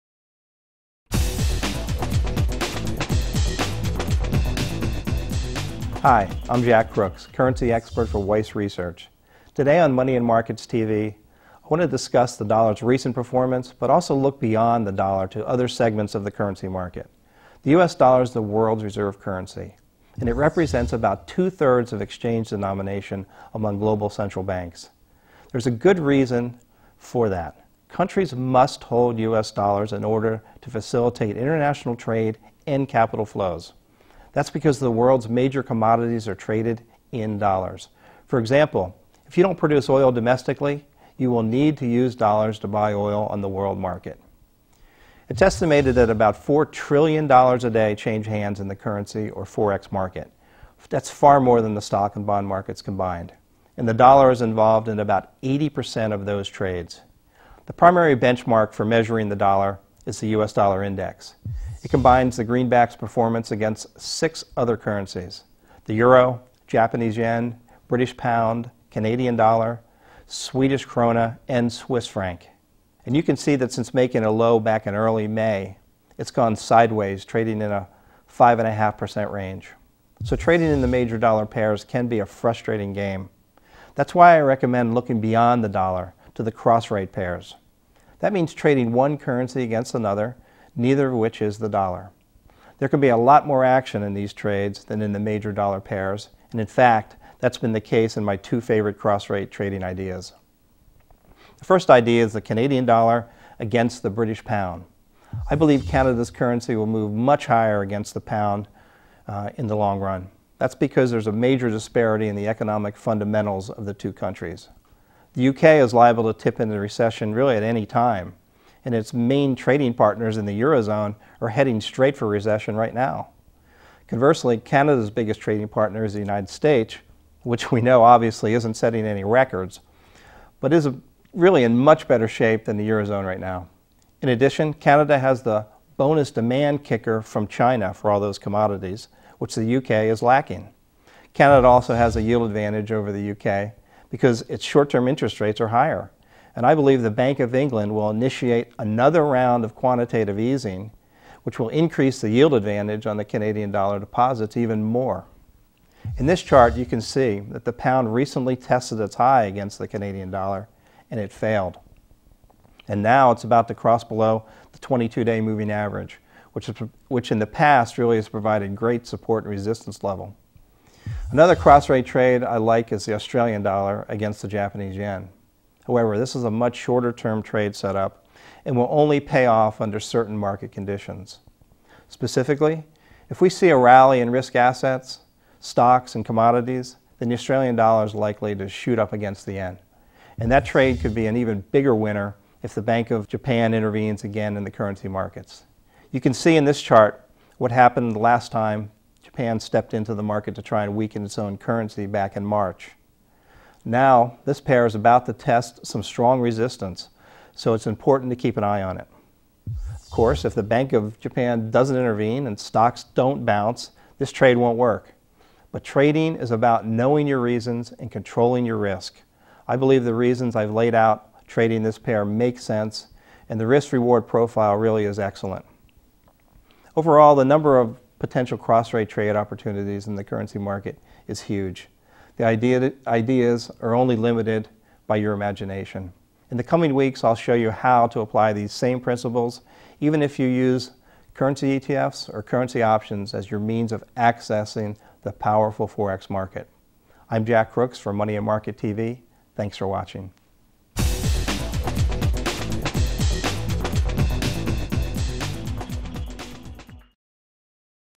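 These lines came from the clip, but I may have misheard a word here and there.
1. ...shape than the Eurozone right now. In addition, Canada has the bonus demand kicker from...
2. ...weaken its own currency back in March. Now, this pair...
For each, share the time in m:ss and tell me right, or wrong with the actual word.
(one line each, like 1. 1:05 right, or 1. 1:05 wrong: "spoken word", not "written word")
1. 2:12 right
2. 3:20 right.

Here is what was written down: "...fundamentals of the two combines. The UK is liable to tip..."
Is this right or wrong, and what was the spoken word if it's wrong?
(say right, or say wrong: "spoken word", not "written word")
wrong: "countries", not "combines".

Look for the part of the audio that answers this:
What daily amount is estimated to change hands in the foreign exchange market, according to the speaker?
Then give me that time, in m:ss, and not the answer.
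0:46.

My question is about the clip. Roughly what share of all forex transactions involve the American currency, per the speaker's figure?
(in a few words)
80%.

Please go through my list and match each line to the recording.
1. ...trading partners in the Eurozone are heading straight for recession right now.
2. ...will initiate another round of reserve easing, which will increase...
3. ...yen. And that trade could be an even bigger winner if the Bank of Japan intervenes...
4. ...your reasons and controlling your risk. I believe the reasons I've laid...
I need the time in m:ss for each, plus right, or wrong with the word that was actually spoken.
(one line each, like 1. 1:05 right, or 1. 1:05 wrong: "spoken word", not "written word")
1. 1:59 right
2. 2:27 wrong: "quantitative", not "reserve"
3. 3:09 right
4. 3:37 right.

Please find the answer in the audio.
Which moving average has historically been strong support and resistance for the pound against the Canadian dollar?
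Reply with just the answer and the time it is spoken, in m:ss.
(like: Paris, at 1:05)
22-day moving average, at 2:44.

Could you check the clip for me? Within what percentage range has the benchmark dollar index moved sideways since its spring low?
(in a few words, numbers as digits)
5.5%.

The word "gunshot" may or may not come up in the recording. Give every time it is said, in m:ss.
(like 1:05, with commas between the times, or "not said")
not said.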